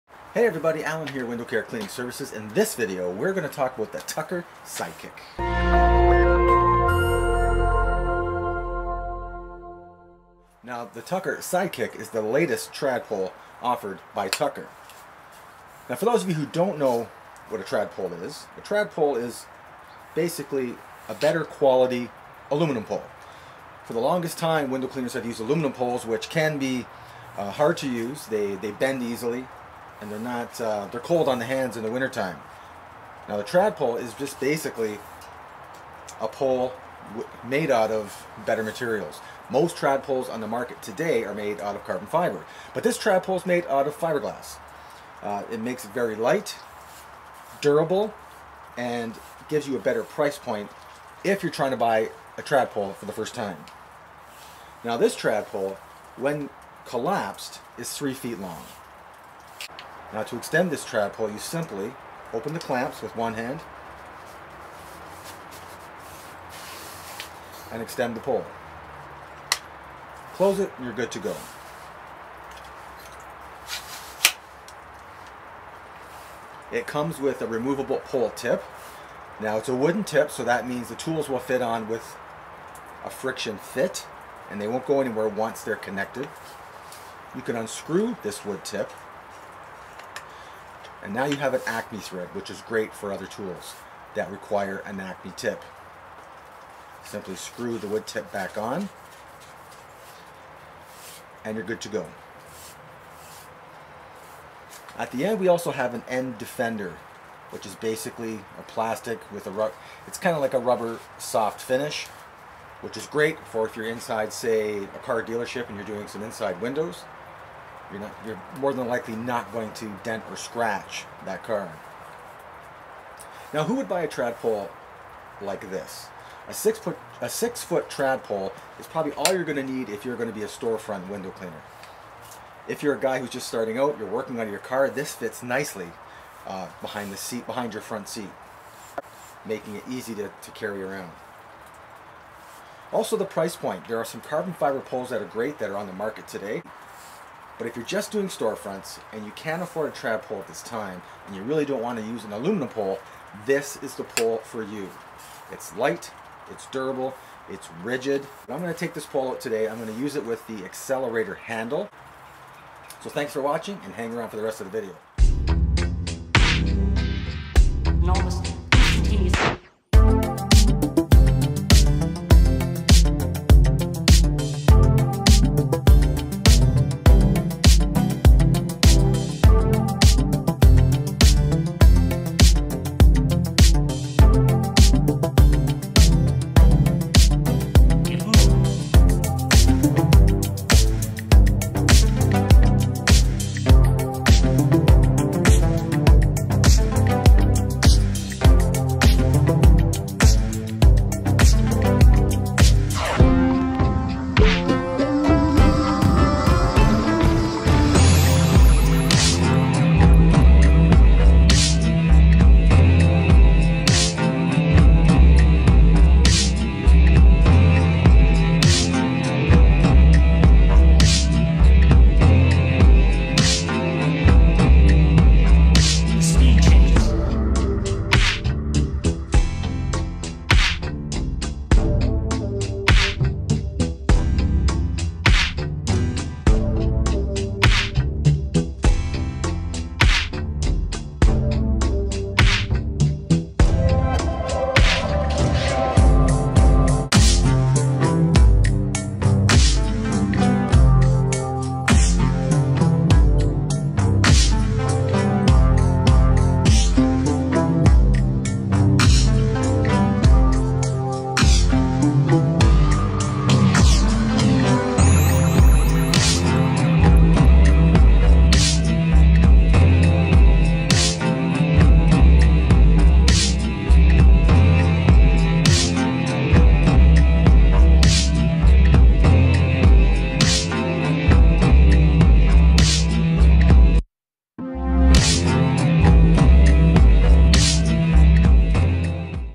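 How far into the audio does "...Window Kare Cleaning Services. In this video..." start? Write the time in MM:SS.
00:01.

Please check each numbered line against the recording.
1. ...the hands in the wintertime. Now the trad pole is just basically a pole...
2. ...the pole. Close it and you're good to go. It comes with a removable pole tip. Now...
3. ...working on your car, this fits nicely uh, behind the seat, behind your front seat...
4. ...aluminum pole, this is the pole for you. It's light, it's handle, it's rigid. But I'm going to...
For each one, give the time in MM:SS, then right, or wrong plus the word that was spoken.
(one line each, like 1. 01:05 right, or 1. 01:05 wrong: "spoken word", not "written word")
1. 00:31 right
2. 01:08 right
3. 02:14 right
4. 02:32 wrong: "durable", not "handle".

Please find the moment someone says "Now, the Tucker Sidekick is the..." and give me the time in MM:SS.
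00:10.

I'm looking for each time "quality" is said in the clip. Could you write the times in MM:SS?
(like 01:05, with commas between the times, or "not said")
00:21.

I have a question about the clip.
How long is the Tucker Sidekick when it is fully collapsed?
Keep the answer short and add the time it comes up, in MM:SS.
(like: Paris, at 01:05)
3 feet, at 00:57.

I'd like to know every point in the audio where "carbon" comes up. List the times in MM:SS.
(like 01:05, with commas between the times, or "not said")
00:41, 02:24.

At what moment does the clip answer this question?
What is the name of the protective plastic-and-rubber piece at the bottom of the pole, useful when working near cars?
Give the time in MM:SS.
01:46.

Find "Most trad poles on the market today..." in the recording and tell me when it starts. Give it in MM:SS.
00:39.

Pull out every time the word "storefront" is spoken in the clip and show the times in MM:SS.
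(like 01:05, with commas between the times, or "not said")
02:10, 02:28.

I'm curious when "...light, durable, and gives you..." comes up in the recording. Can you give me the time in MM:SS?
00:46.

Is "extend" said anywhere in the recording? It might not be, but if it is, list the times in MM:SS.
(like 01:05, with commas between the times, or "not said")
01:00, 01:07.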